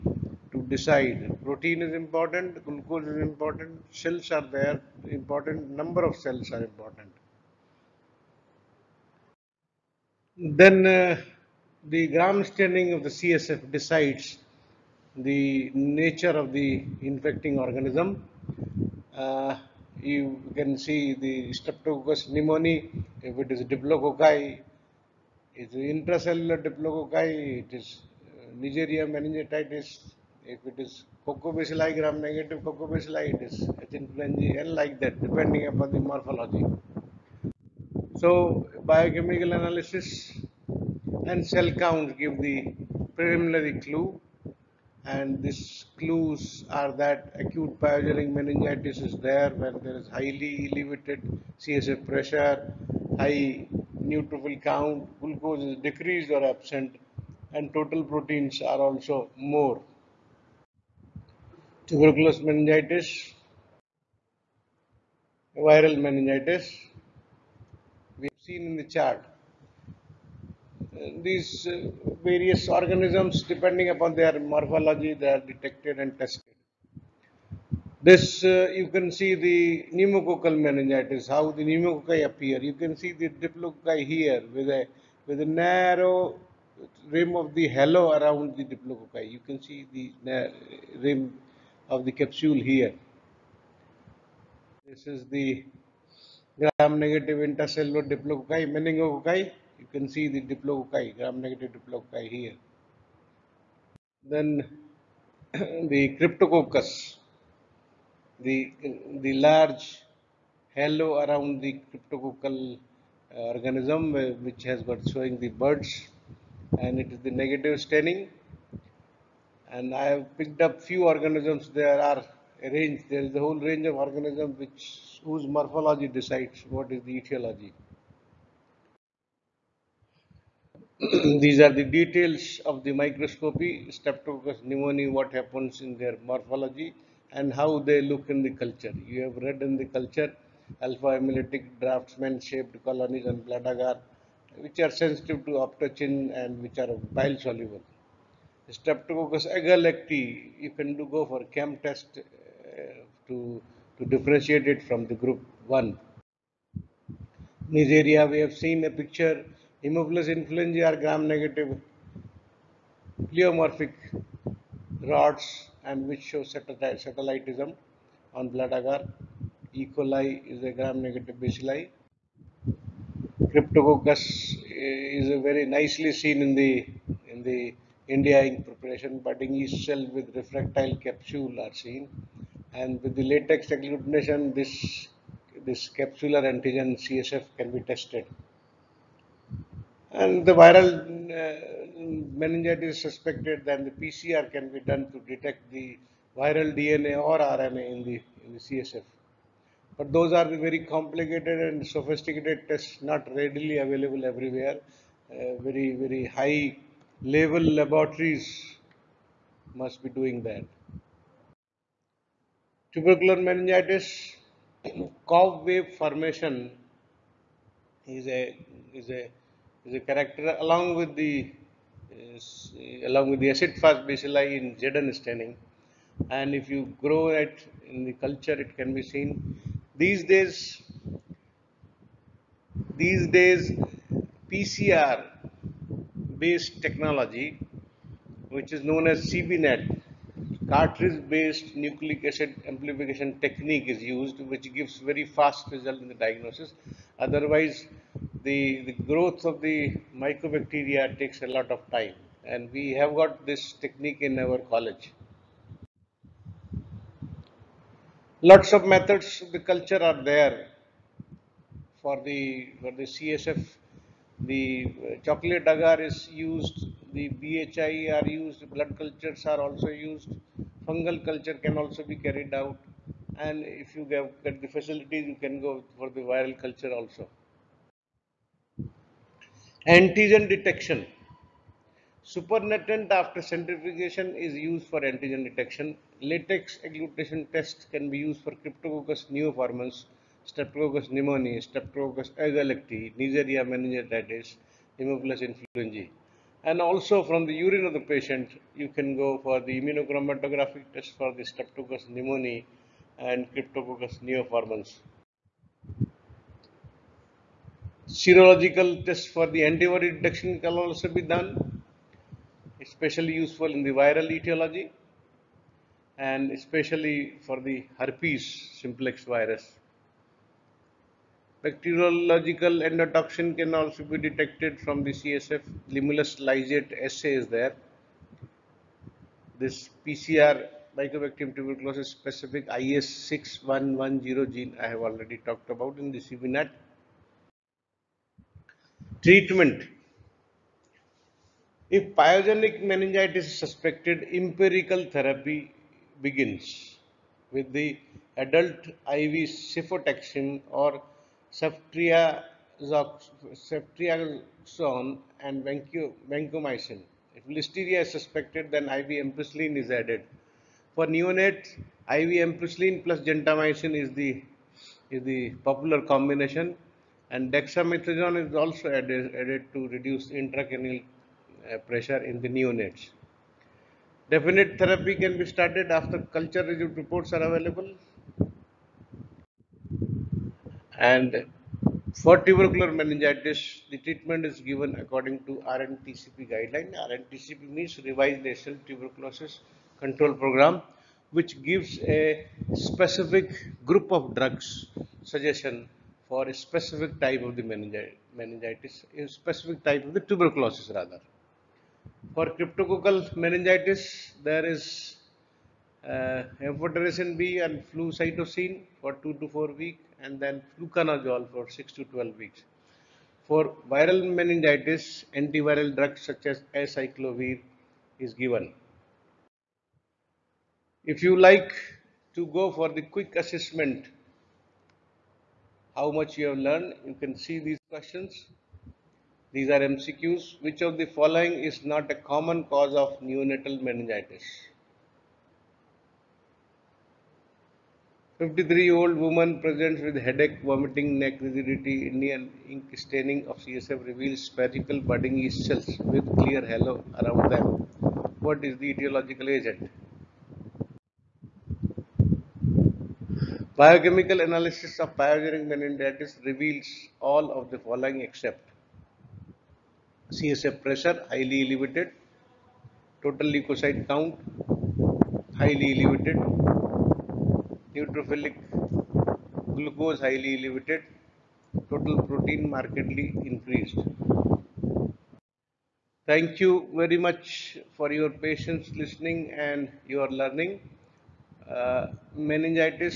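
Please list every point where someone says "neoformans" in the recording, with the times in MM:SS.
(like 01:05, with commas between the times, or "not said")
04:49, 05:04.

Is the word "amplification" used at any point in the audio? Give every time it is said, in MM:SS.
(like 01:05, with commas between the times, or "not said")
04:02.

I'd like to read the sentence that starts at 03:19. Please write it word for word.
But those are the very complicated and sophisticated tests not readily available everywhere.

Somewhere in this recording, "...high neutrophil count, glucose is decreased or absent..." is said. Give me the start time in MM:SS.
00:53.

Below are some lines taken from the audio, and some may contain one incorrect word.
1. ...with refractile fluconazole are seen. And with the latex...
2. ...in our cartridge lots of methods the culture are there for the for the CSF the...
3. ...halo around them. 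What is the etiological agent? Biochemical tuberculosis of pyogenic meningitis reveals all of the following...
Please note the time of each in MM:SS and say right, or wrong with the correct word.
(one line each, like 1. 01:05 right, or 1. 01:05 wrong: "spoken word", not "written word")
1. 03:00 wrong: "capsule", not "fluconazole"
2. 04:14 wrong: "college", not "cartridge"
3. 07:26 wrong: "analysis", not "tuberculosis".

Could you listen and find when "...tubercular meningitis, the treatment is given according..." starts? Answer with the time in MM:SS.
06:22.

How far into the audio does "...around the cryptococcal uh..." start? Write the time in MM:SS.
01:51.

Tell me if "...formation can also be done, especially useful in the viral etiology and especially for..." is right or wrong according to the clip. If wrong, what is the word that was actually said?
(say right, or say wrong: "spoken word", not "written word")
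wrong: "detection", not "formation".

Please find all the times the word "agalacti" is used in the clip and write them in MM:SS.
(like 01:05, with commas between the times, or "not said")
02:29, 04:52.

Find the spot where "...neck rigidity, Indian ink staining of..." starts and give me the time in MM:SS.
07:21.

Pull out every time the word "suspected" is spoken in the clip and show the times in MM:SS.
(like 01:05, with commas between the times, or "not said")
03:12, 05:43, 05:58.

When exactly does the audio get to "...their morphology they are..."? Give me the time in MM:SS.
01:14.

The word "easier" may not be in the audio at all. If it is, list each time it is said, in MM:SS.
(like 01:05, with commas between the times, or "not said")
not said.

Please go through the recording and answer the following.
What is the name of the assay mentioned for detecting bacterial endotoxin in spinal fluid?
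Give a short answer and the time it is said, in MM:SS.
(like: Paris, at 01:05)
Limulus lysate assay, at 05:25.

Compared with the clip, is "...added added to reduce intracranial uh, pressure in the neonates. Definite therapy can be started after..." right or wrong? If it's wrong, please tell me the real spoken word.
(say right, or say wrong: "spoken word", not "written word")
right.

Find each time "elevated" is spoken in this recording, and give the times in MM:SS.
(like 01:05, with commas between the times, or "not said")
00:50, 07:41, 07:46, 07:50.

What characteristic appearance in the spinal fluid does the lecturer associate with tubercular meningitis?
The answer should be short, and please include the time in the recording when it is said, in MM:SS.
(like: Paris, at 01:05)
Cobweb formation, at 03:35.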